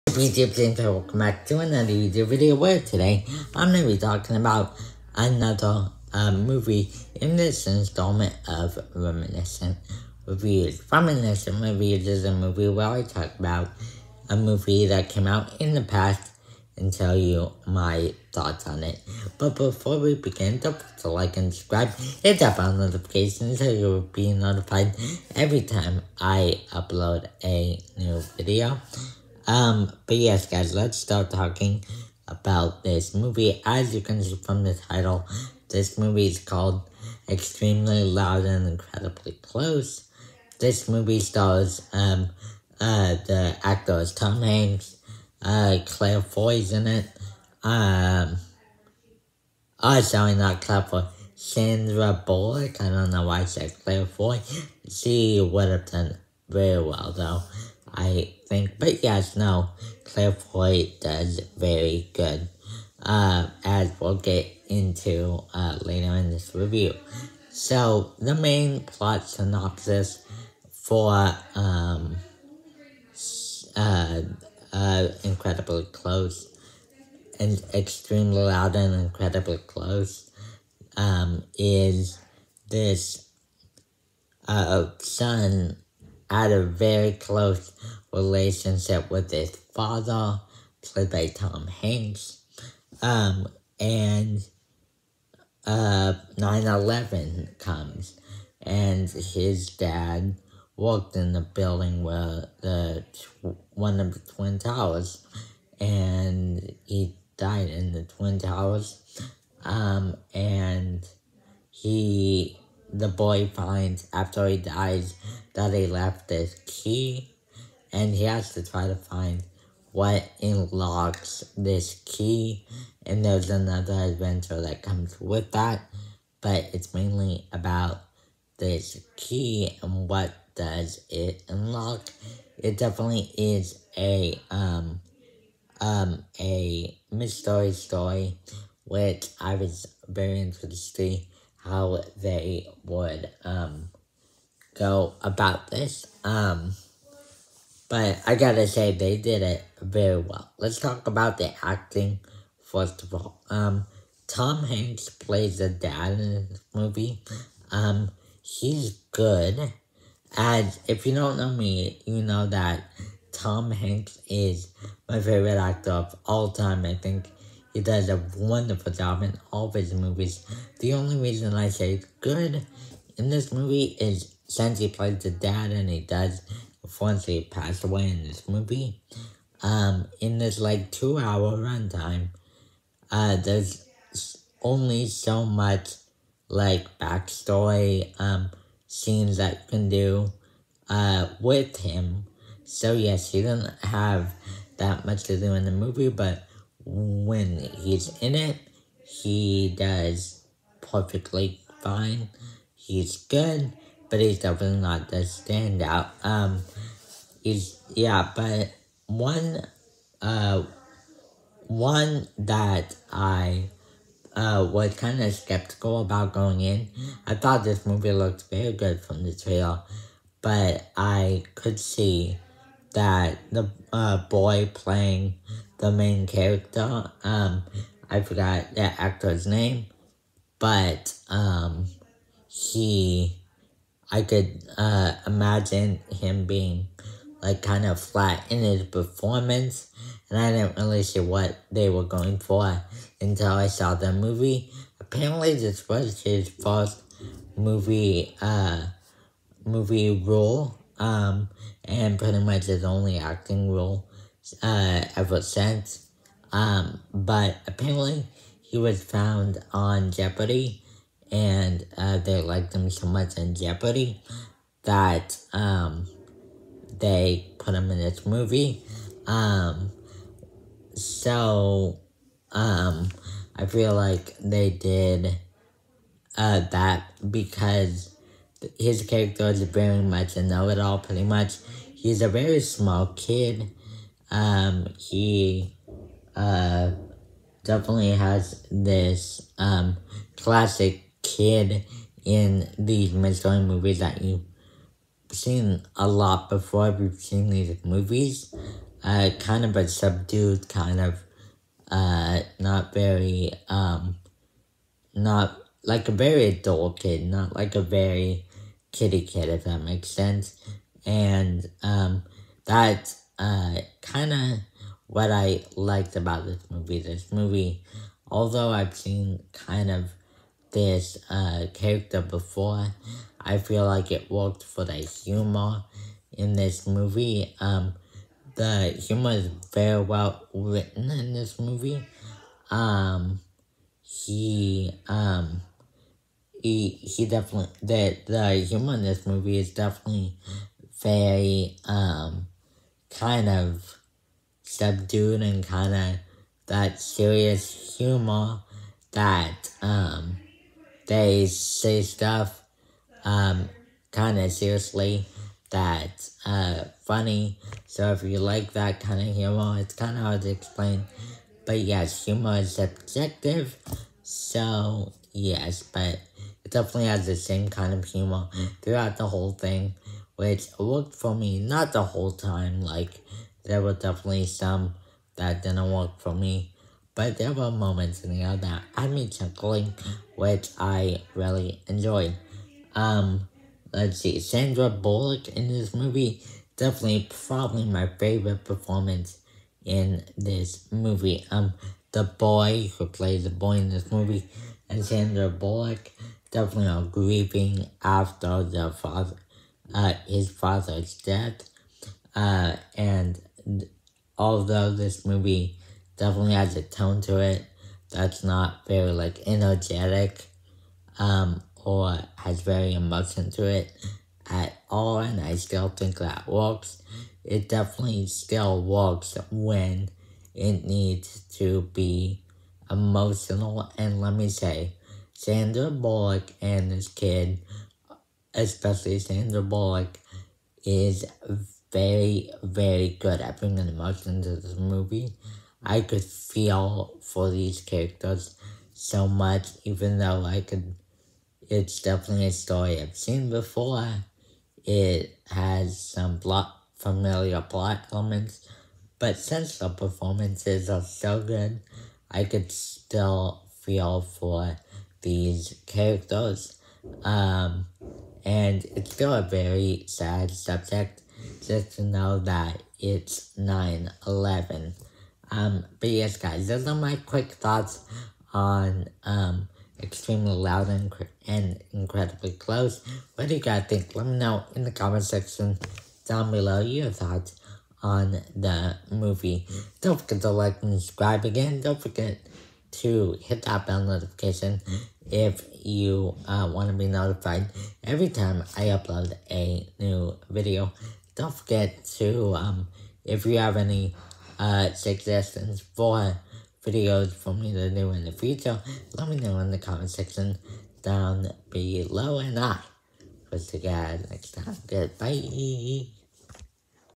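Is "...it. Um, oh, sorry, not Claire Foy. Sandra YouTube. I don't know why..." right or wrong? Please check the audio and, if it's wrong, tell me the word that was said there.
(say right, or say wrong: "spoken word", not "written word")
wrong: "Bullock", not "YouTube".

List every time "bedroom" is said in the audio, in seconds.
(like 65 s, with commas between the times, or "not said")
not said.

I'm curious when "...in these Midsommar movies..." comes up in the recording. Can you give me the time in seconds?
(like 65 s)
292 s.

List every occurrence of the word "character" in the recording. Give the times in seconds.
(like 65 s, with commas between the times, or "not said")
226 s, 279 s, 321 s, 437 s, 455 s.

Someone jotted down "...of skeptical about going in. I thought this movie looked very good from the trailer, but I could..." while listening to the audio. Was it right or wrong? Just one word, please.
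right.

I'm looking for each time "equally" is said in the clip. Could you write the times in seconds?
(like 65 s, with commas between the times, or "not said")
not said.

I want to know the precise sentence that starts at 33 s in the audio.
As you can see from the title, this movie is called Extremely Loud and Incredibly Close.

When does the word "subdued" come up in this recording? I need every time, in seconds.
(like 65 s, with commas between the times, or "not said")
299 s, 344 s.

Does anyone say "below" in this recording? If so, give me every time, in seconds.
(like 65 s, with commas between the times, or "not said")
476 s, 501 s.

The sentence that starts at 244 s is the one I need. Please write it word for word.
Apparently, this was his first movie, uh, movie role um, and pretty much his only acting role uh, ever since.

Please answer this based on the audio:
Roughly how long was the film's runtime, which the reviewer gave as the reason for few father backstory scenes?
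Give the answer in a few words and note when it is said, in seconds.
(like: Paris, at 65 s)
2 hours, at 180 s.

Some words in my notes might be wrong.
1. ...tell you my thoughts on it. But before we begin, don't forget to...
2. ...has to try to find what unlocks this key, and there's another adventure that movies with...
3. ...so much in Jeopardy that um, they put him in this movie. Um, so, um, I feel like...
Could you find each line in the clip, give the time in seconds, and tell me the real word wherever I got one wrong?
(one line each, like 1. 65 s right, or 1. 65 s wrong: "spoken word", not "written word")
1. 16 s right
2. 118 s wrong: "comes", not "movies"
3. 262 s right.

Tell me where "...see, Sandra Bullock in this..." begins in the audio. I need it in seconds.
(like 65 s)
384 s.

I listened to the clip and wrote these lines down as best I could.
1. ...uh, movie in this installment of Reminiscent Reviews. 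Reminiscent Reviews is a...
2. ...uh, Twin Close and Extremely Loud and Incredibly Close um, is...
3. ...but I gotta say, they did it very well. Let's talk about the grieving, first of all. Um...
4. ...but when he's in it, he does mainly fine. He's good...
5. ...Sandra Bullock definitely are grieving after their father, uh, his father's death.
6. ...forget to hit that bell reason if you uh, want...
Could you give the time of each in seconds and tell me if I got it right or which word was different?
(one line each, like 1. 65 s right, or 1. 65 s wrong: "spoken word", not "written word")
1. 6 s right
2. 74 s wrong: "Incredibly", not "Twin"
3. 147 s wrong: "acting", not "grieving"
4. 196 s wrong: "perfectly", not "mainly"
5. 395 s right
6. 482 s wrong: "notification", not "reason".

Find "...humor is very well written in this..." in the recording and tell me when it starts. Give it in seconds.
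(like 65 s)
328 s.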